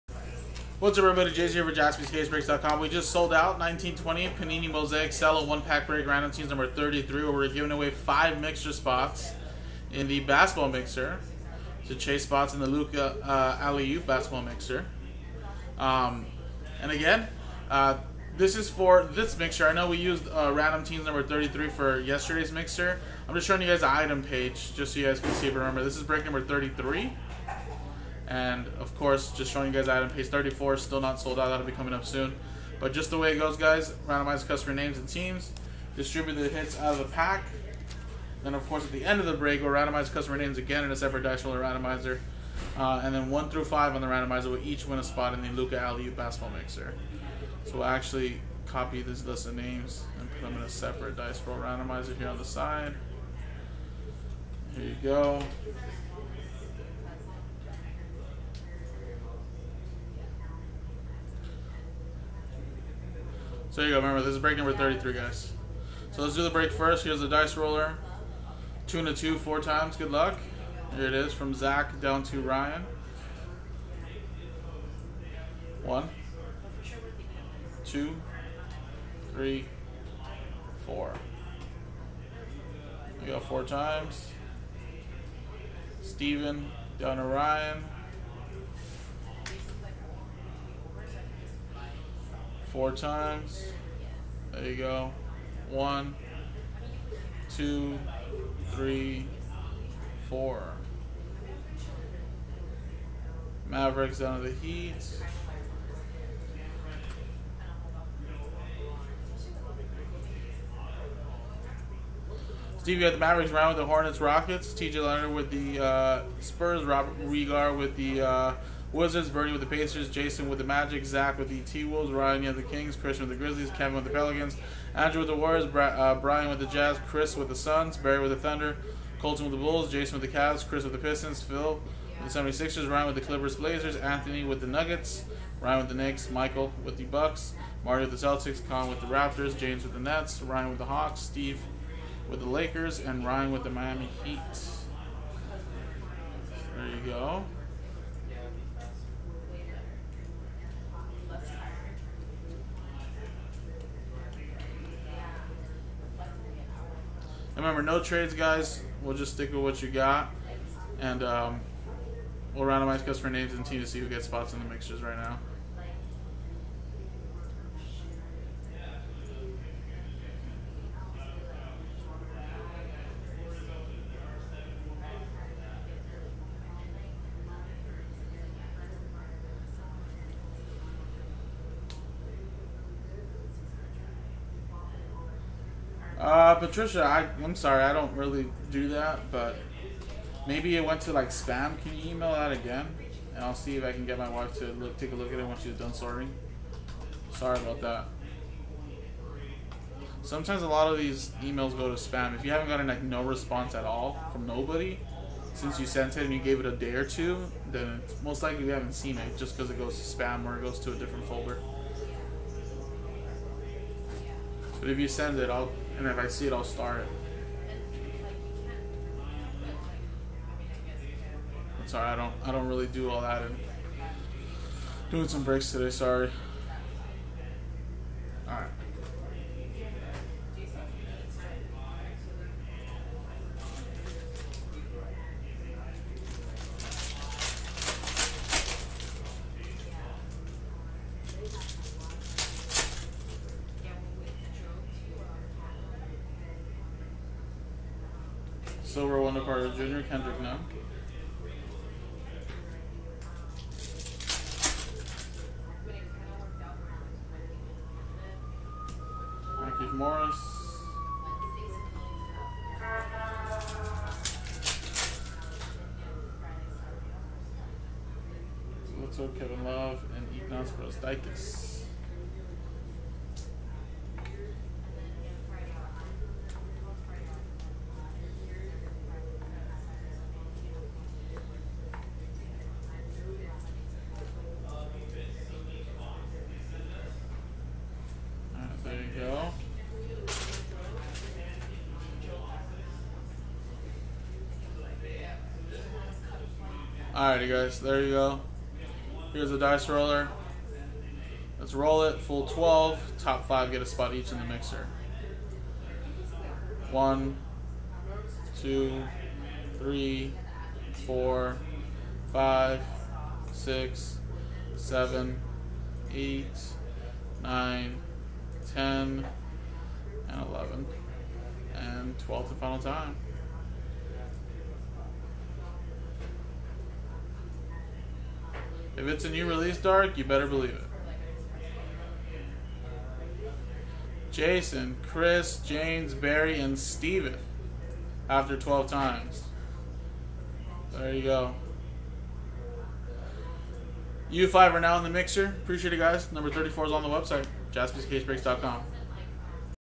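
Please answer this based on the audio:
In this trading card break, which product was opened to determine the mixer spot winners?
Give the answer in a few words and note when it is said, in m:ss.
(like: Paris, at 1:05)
Panini Mosaic Cello, at 0:04.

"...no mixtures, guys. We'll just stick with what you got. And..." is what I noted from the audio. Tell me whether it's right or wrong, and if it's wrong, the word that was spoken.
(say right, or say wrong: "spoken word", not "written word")
wrong: "trades", not "mixtures".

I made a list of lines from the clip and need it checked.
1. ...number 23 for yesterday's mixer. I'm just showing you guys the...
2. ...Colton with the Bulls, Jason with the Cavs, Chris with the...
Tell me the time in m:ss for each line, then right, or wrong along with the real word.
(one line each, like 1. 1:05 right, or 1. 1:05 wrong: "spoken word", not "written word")
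1. 0:21 wrong: "33", not "23"
2. 2:09 right.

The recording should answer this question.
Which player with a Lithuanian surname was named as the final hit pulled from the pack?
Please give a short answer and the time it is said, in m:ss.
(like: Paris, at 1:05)
Ignas Brazdeikis, at 4:30.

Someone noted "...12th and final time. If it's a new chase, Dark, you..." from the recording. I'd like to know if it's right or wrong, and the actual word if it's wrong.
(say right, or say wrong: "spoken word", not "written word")
wrong: "release", not "chase".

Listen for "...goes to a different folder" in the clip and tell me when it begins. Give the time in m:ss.
3:30.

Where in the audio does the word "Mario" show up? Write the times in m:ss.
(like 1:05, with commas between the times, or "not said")
2:17.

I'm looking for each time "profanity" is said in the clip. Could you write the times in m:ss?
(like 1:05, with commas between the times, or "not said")
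not said.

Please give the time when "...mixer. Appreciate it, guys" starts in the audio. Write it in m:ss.
5:45.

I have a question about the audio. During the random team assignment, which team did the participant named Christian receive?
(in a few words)
Grizzlies.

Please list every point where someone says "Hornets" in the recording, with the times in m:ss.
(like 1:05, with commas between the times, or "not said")
1:53.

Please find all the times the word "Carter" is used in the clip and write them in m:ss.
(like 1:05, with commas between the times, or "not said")
4:09.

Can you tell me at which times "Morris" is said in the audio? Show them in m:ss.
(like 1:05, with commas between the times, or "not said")
4:19.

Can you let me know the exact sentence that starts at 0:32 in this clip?
But just the way it goes, guys, randomize customer names and teams, distribute the hits out of the pack.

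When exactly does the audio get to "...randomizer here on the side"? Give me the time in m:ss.
0:51.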